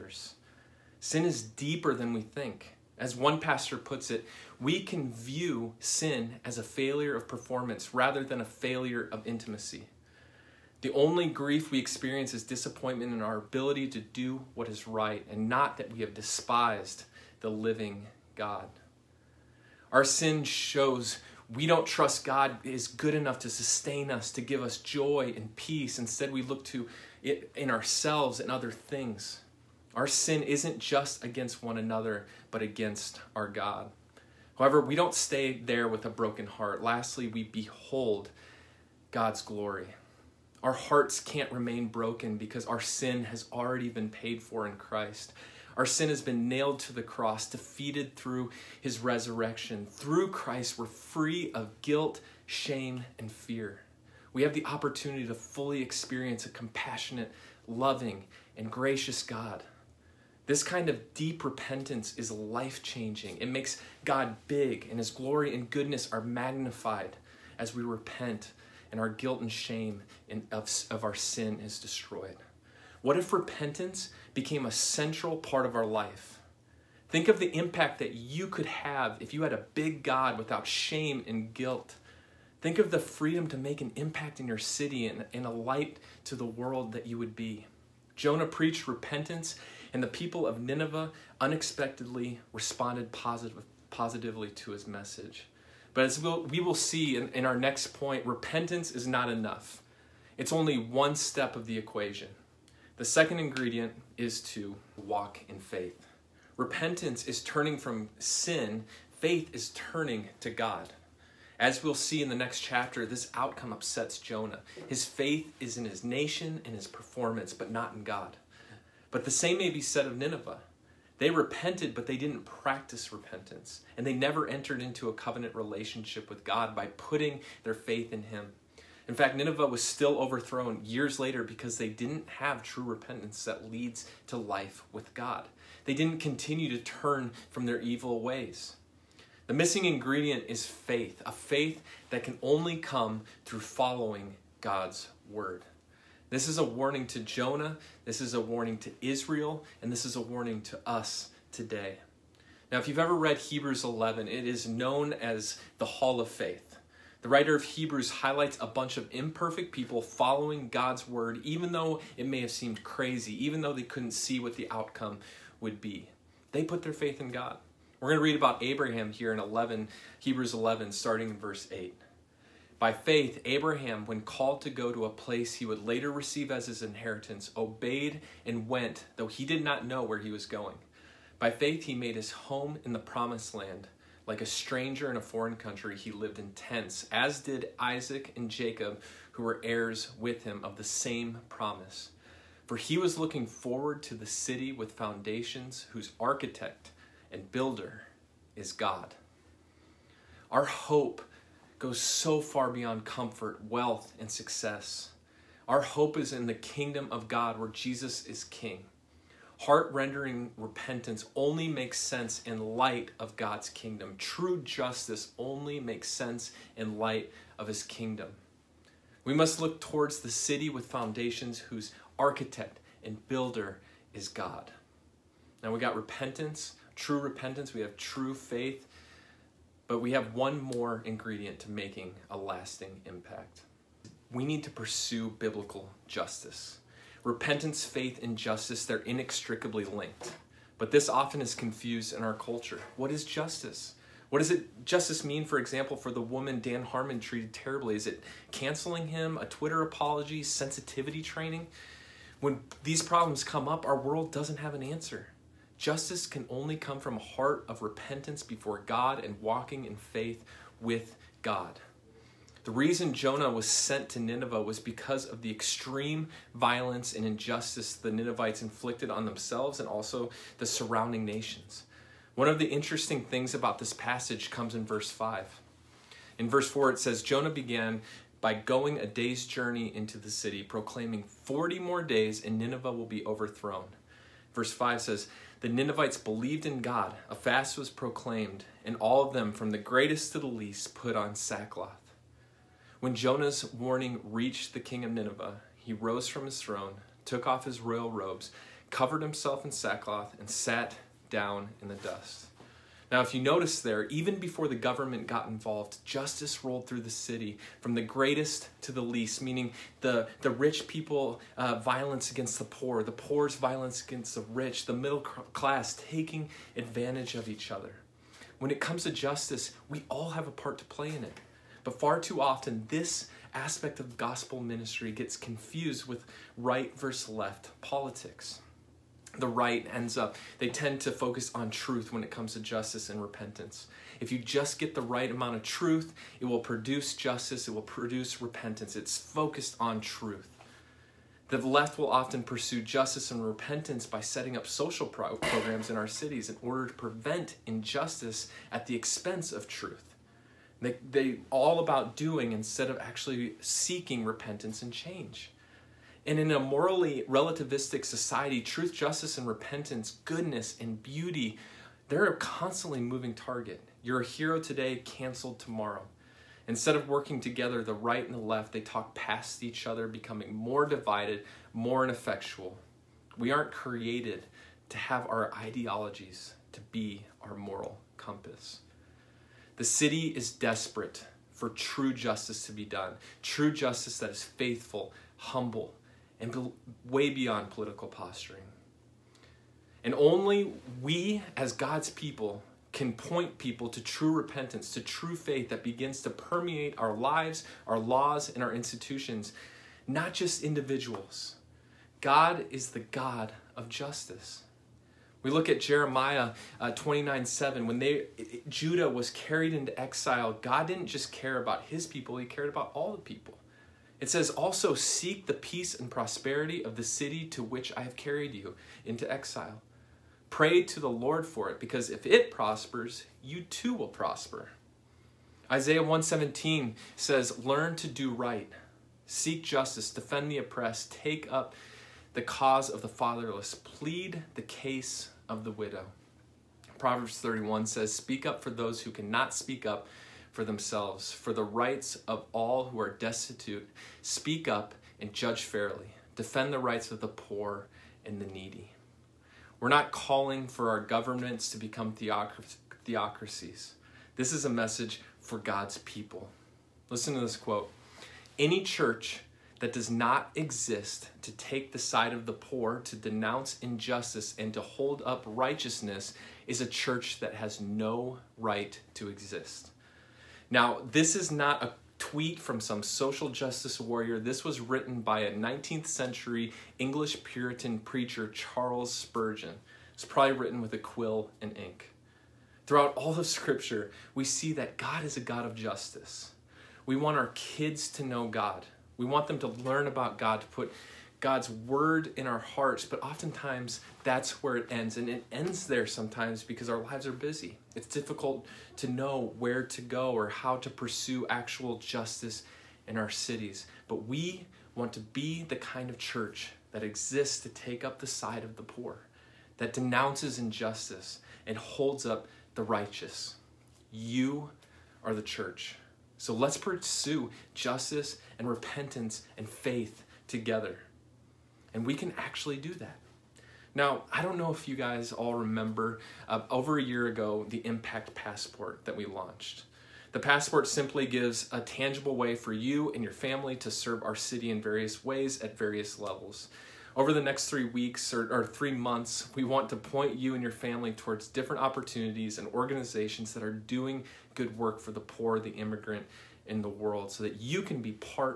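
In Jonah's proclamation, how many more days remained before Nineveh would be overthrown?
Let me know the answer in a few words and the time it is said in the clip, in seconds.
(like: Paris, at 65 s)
40, at 281 s.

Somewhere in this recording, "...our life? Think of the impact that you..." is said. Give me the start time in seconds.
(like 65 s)
75 s.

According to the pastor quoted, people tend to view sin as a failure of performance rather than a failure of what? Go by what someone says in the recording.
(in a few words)
intimacy.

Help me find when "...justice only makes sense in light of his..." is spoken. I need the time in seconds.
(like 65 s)
214 s.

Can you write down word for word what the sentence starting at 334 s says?
If you just get the right amount of truth, it will produce justice, it will produce repentance.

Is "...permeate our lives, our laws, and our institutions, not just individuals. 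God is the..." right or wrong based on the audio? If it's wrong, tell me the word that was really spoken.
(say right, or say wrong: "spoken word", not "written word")
right.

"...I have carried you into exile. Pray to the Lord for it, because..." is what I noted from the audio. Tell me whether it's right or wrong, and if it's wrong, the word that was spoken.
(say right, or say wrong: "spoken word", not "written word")
right.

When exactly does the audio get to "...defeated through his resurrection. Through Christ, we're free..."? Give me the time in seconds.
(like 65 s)
47 s.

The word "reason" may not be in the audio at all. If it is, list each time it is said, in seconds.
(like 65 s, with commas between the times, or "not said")
262 s.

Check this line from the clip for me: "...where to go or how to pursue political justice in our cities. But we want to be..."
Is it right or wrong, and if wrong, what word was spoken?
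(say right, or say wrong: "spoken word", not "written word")
wrong: "actual", not "political".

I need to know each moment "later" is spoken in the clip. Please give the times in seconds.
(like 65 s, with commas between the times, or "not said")
131 s, 175 s.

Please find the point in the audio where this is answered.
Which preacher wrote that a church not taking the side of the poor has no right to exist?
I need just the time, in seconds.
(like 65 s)
478 s.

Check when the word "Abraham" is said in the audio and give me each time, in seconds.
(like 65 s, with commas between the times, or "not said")
168 s, 173 s.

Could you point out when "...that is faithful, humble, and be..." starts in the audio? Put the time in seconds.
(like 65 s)
384 s.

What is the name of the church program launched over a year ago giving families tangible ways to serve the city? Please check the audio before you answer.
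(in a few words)
Impact Passport.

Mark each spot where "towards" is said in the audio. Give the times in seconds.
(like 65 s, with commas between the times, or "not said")
219 s, 541 s.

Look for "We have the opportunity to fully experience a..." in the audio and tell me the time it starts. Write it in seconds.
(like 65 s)
54 s.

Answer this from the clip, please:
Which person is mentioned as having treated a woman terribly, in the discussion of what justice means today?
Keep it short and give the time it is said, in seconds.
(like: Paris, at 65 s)
Dan Harmon, at 246 s.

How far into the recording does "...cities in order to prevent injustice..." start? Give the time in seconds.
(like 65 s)
346 s.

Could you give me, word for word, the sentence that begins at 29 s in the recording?
Our sin isn't just against one another, but against our God.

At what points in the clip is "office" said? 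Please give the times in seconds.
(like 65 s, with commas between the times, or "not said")
not said.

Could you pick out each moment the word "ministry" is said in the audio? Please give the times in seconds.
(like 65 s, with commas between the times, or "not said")
324 s.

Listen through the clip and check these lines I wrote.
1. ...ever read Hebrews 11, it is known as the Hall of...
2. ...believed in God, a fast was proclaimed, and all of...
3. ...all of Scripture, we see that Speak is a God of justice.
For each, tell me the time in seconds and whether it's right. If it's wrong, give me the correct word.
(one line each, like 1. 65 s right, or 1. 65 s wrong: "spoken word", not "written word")
1. 152 s right
2. 286 s right
3. 483 s wrong: "God", not "Speak".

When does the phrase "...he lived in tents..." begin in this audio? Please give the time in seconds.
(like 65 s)
185 s.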